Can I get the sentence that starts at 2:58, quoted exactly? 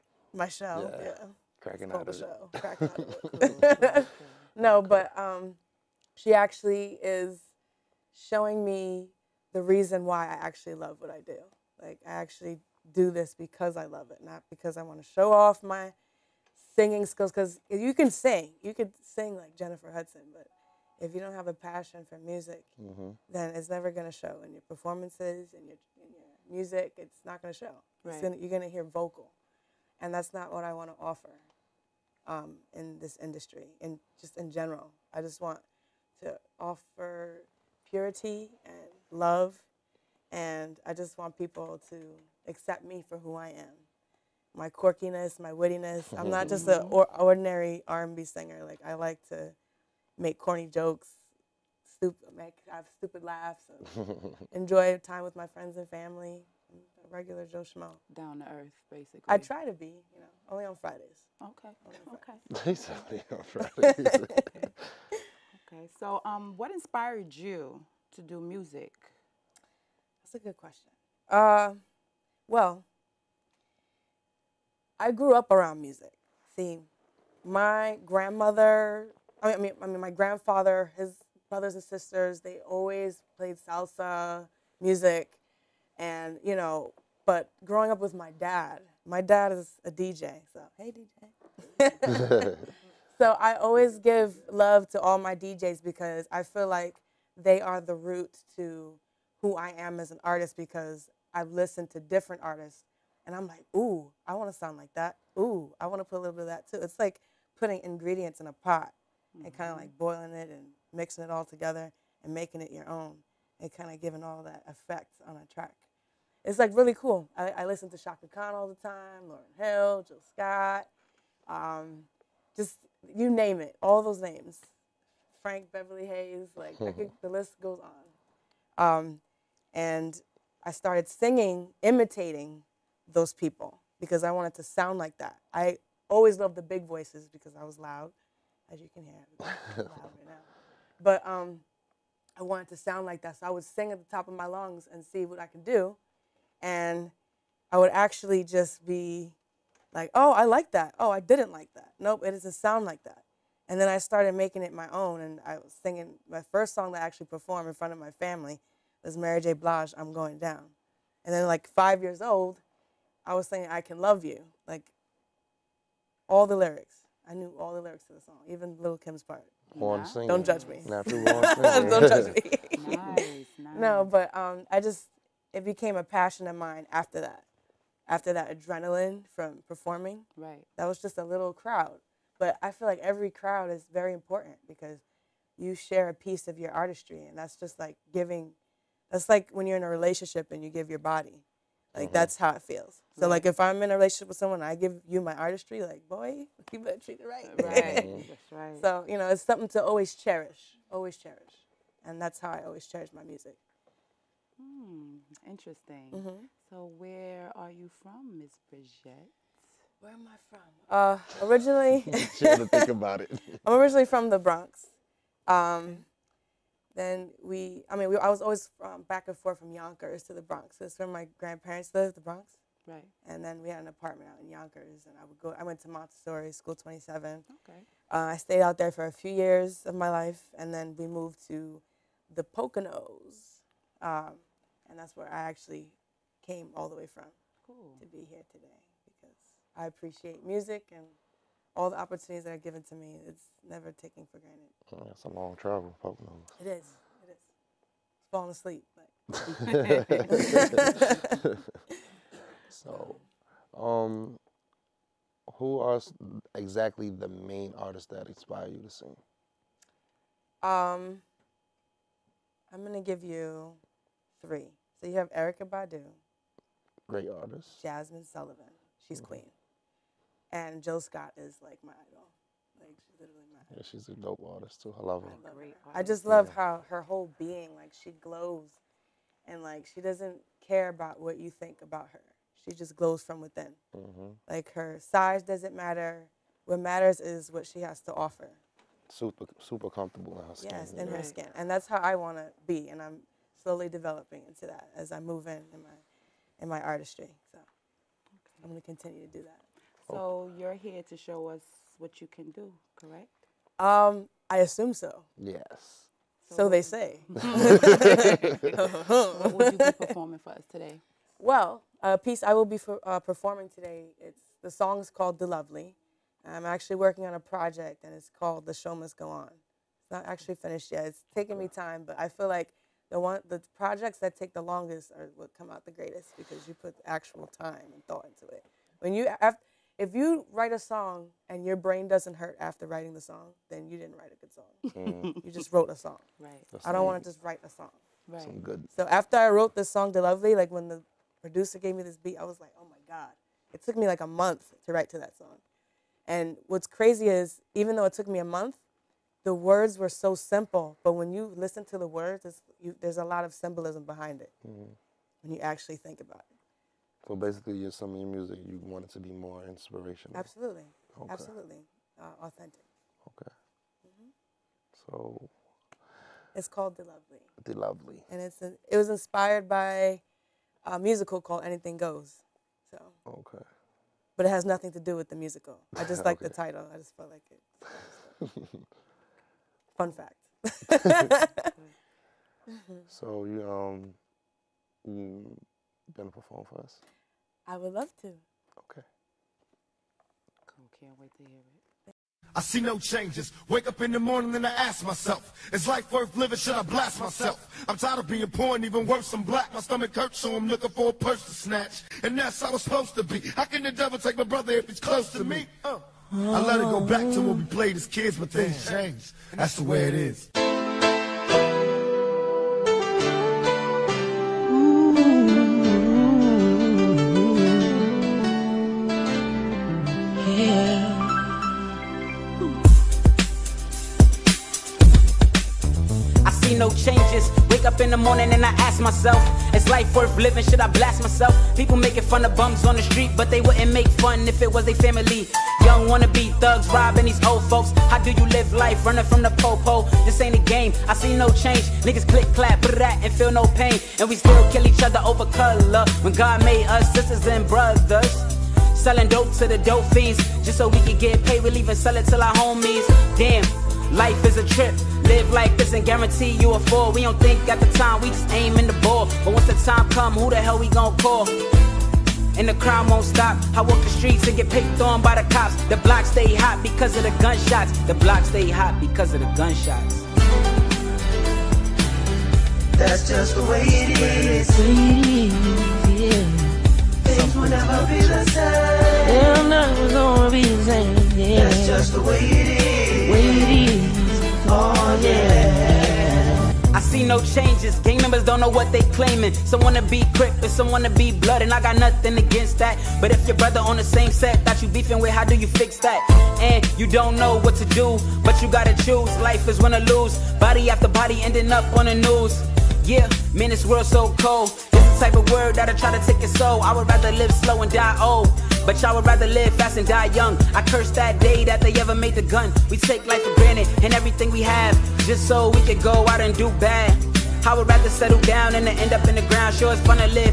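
After that adrenaline from performing, right?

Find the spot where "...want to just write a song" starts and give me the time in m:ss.
5:37.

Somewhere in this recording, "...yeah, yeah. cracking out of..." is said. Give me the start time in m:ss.
0:00.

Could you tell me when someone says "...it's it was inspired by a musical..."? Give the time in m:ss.
6:08.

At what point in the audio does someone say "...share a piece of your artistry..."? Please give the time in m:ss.
3:05.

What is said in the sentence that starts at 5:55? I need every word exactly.
when you actually think about it.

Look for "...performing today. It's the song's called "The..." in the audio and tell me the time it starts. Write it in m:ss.
5:13.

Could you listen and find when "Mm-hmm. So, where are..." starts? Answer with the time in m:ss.
3:26.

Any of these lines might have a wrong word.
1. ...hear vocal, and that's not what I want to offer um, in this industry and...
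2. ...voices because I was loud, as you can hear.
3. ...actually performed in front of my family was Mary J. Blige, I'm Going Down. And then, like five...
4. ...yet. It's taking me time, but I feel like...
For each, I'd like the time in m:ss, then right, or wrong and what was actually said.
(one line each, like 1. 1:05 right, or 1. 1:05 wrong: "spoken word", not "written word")
1. 0:28 right
2. 2:16 right
3. 2:37 right
4. 5:20 right.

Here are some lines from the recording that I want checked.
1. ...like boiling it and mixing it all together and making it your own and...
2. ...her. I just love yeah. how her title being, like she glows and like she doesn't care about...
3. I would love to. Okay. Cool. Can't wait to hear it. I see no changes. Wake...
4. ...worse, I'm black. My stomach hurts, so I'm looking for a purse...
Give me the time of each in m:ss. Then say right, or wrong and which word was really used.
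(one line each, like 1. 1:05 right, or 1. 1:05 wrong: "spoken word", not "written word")
1. 1:49 right
2. 4:35 wrong: "whole", not "title"
3. 6:27 right
4. 6:39 right.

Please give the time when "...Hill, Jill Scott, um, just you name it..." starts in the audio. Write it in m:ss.
1:59.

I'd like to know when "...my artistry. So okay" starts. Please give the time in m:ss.
4:56.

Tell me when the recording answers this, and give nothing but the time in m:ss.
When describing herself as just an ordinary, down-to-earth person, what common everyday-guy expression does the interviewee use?
0:57.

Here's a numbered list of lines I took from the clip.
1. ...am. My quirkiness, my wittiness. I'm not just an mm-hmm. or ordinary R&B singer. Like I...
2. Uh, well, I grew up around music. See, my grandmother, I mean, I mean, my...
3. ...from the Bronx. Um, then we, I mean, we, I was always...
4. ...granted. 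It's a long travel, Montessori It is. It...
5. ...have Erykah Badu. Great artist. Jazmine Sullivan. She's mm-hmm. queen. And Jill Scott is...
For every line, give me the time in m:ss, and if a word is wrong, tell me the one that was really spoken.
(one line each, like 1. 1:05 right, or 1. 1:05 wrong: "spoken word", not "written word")
1. 0:43 right
2. 1:11 right
3. 3:34 right
4. 4:04 wrong: "Pope", not "Montessori"
5. 4:25 right.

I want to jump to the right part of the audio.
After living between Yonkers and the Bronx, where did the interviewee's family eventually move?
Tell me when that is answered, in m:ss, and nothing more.
3:52.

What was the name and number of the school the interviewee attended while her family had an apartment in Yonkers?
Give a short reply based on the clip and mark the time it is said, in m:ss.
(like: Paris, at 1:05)
Montessori School 27, at 3:45.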